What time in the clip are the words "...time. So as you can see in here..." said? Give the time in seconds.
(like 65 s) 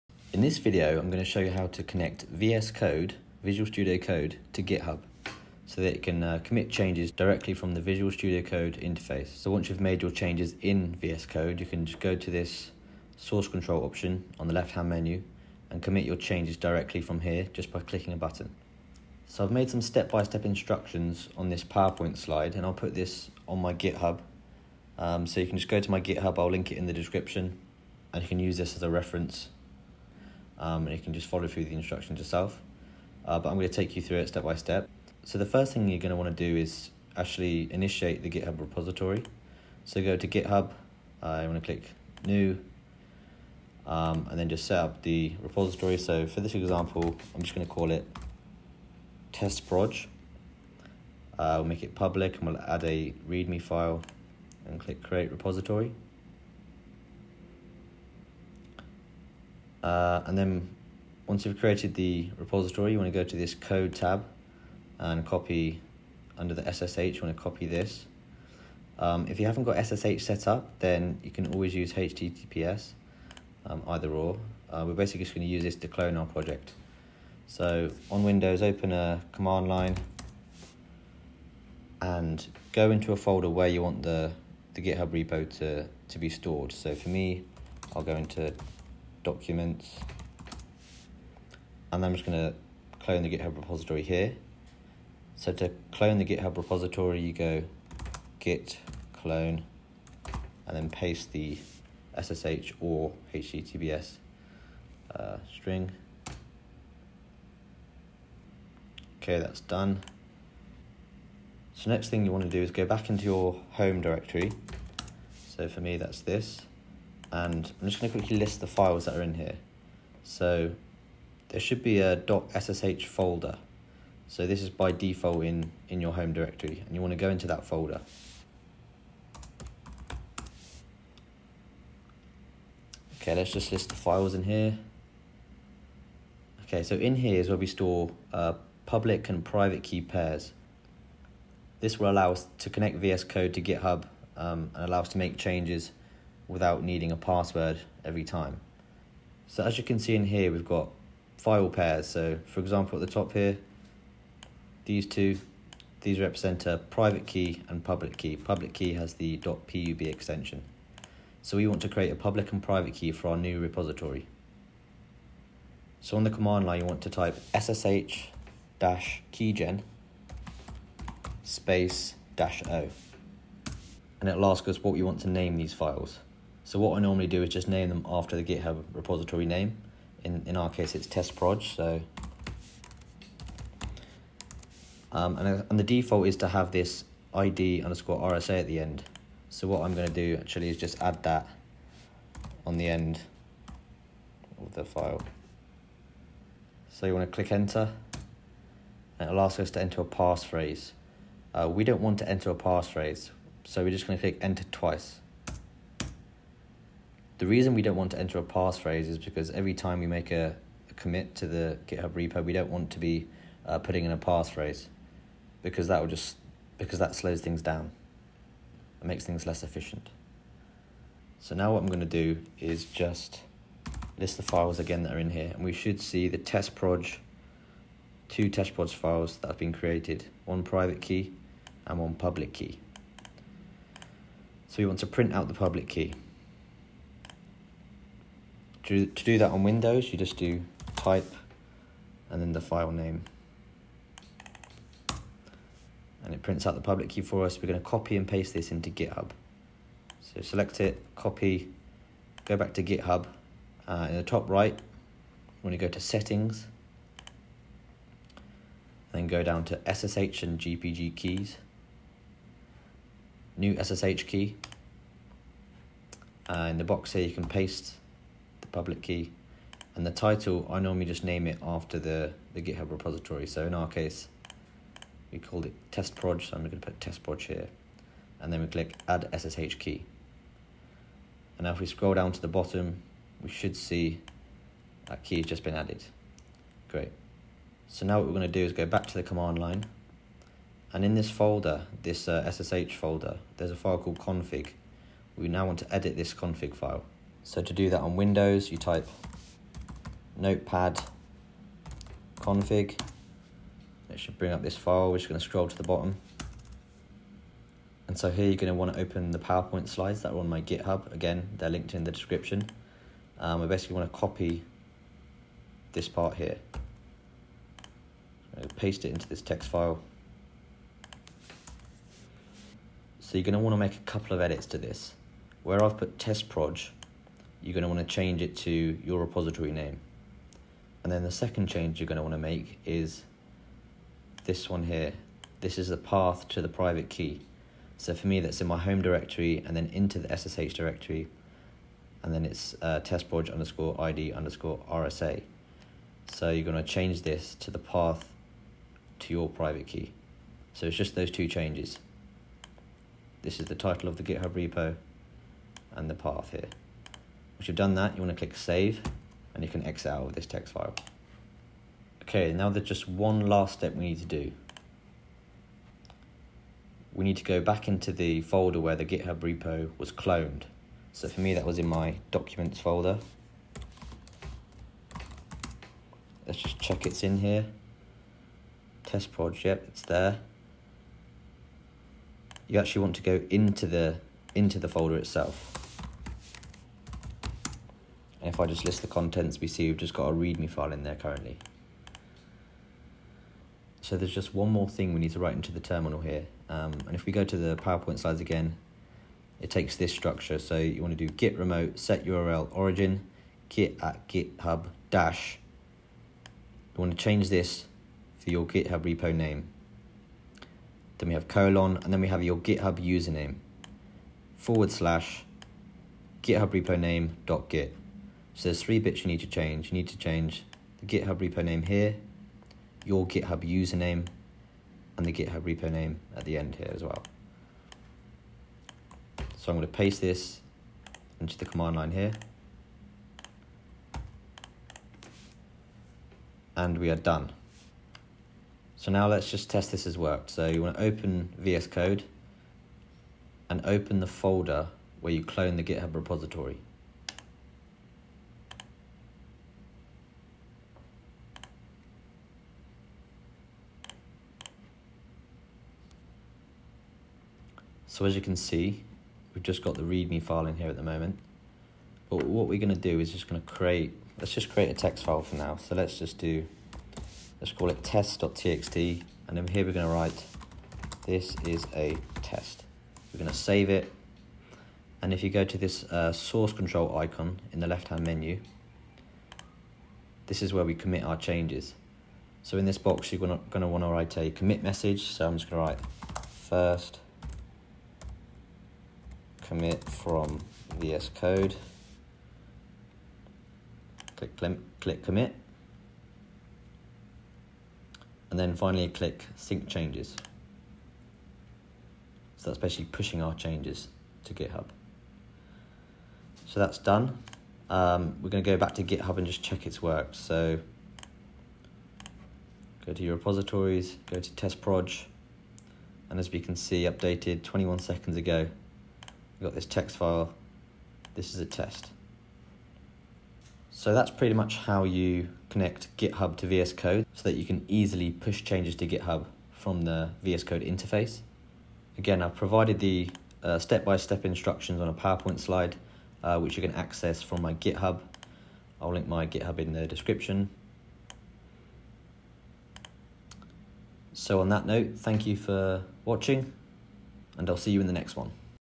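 148 s.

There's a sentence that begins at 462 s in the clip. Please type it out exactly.
But what we're going to do is just going to create, let's just create a text file for now.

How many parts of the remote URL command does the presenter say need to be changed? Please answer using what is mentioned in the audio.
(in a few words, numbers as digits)
3.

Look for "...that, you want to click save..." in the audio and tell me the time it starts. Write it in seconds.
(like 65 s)
357 s.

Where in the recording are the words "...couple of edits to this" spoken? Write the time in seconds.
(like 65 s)
323 s.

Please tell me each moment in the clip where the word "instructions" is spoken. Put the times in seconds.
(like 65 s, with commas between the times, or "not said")
20 s, 31 s, 534 s.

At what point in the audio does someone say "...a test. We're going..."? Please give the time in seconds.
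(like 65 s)
471 s.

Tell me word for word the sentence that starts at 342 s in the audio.
And then it's uh, testproj underscore ID underscore RSA.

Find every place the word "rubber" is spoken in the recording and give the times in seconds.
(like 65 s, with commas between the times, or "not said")
not said.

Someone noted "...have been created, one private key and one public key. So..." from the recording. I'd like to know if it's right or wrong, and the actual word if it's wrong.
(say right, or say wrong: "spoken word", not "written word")
right.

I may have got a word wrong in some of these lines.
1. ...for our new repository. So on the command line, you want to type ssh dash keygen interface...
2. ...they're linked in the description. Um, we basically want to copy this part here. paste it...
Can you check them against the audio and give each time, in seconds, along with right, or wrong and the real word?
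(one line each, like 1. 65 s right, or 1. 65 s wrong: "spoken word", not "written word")
1. 163 s wrong: "space", not "interface"
2. 311 s right.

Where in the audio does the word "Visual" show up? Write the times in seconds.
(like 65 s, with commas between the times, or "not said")
3 s, 7 s.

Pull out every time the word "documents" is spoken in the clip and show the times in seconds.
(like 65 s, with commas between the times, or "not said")
89 s, 372 s.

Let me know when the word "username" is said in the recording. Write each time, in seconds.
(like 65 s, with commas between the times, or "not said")
412 s, 423 s.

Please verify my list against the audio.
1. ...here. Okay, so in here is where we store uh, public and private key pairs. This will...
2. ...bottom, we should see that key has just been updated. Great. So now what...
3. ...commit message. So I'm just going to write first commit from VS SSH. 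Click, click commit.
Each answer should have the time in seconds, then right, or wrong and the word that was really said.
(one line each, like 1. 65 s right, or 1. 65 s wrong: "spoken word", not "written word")
1. 134 s right
2. 282 s wrong: "added", not "updated"
3. 484 s wrong: "Code", not "SSH".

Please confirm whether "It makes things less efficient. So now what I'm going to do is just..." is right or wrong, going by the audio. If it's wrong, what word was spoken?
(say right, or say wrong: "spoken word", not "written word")
right.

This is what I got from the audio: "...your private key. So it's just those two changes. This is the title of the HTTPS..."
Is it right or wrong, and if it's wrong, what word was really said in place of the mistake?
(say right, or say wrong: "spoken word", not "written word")
wrong: "GitHub", not "HTTPS".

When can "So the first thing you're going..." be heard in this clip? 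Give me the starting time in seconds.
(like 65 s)
35 s.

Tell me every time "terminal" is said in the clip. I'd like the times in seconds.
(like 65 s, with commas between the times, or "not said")
395 s.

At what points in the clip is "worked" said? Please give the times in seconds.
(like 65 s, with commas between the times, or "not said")
440 s, 510 s.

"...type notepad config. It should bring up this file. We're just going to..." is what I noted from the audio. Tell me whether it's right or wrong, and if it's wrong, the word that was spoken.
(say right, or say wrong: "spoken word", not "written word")
right.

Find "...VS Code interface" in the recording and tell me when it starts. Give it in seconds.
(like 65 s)
530 s.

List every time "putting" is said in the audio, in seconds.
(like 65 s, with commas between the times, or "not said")
213 s.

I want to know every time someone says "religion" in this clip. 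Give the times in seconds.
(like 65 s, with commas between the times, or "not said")
not said.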